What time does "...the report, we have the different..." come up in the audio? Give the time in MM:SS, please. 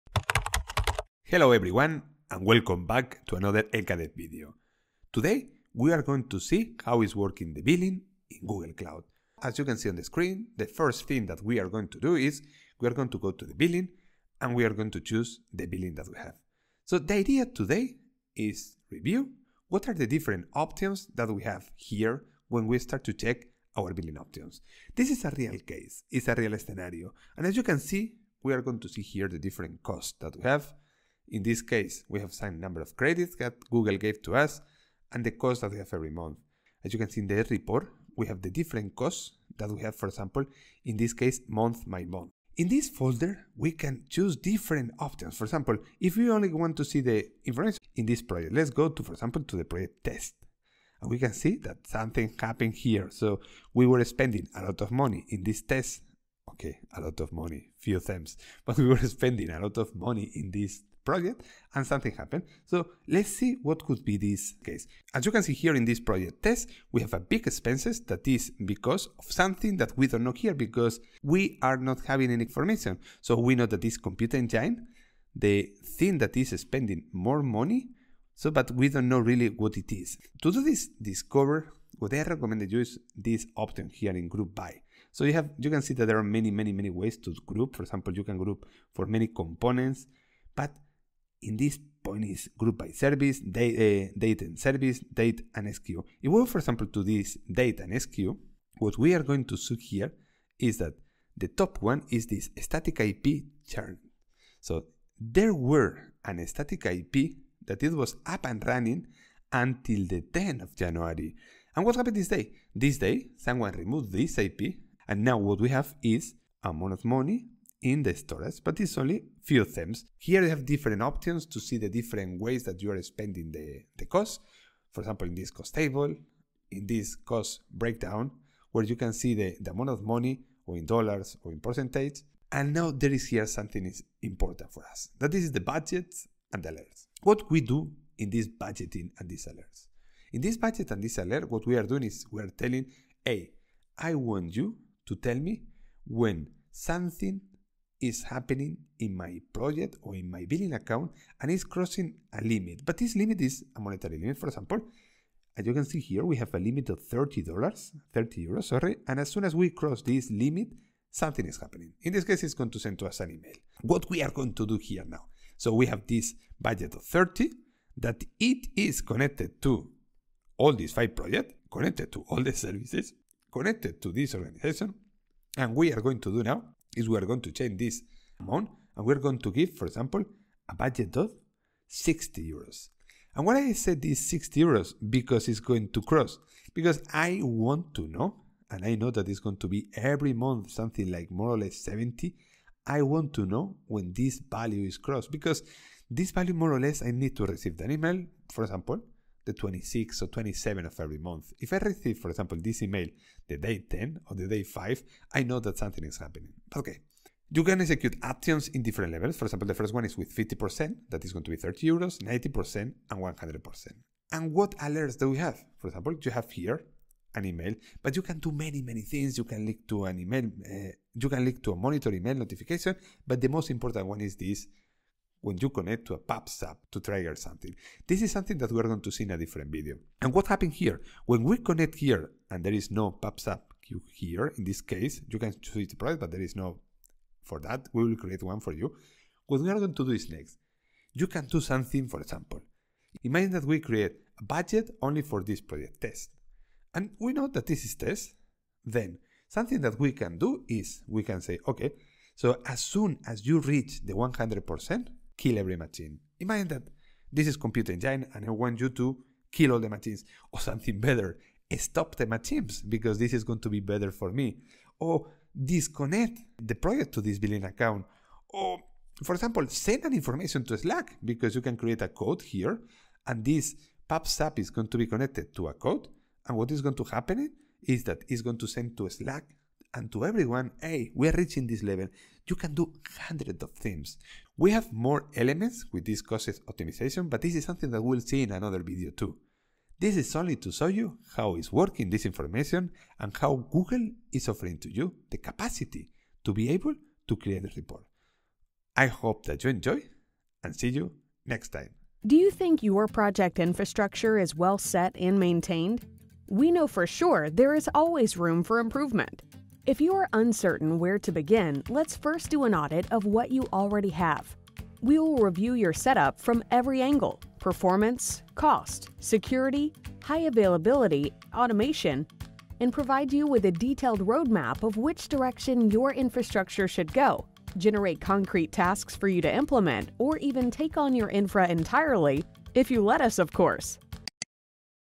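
00:37.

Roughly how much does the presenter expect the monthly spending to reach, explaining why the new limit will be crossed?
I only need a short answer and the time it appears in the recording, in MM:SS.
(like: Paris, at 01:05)
70, at 03:11.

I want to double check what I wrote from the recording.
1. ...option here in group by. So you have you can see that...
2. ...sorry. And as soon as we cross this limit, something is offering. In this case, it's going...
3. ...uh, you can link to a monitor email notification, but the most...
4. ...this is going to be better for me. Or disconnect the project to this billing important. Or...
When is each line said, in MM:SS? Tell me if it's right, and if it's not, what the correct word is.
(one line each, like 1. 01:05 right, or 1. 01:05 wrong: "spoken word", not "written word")
1. 01:23 right
2. 02:38 wrong: "happening", not "offering"
3. 03:40 right
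4. 04:23 wrong: "account", not "important".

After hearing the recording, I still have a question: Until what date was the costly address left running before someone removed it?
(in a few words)
10th of January.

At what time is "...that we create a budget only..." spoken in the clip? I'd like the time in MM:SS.
04:03.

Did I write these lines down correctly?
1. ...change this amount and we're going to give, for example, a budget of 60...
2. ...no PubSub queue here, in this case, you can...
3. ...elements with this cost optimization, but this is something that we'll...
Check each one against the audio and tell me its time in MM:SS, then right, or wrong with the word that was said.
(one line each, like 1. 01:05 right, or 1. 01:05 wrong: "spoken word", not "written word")
1. 02:57 right
2. 03:52 right
3. 04:45 right.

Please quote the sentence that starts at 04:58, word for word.
I hope that you enjoy and see you next time.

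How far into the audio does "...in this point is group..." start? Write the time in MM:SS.
01:31.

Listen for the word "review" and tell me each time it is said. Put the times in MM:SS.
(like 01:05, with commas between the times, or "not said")
00:18, 05:15.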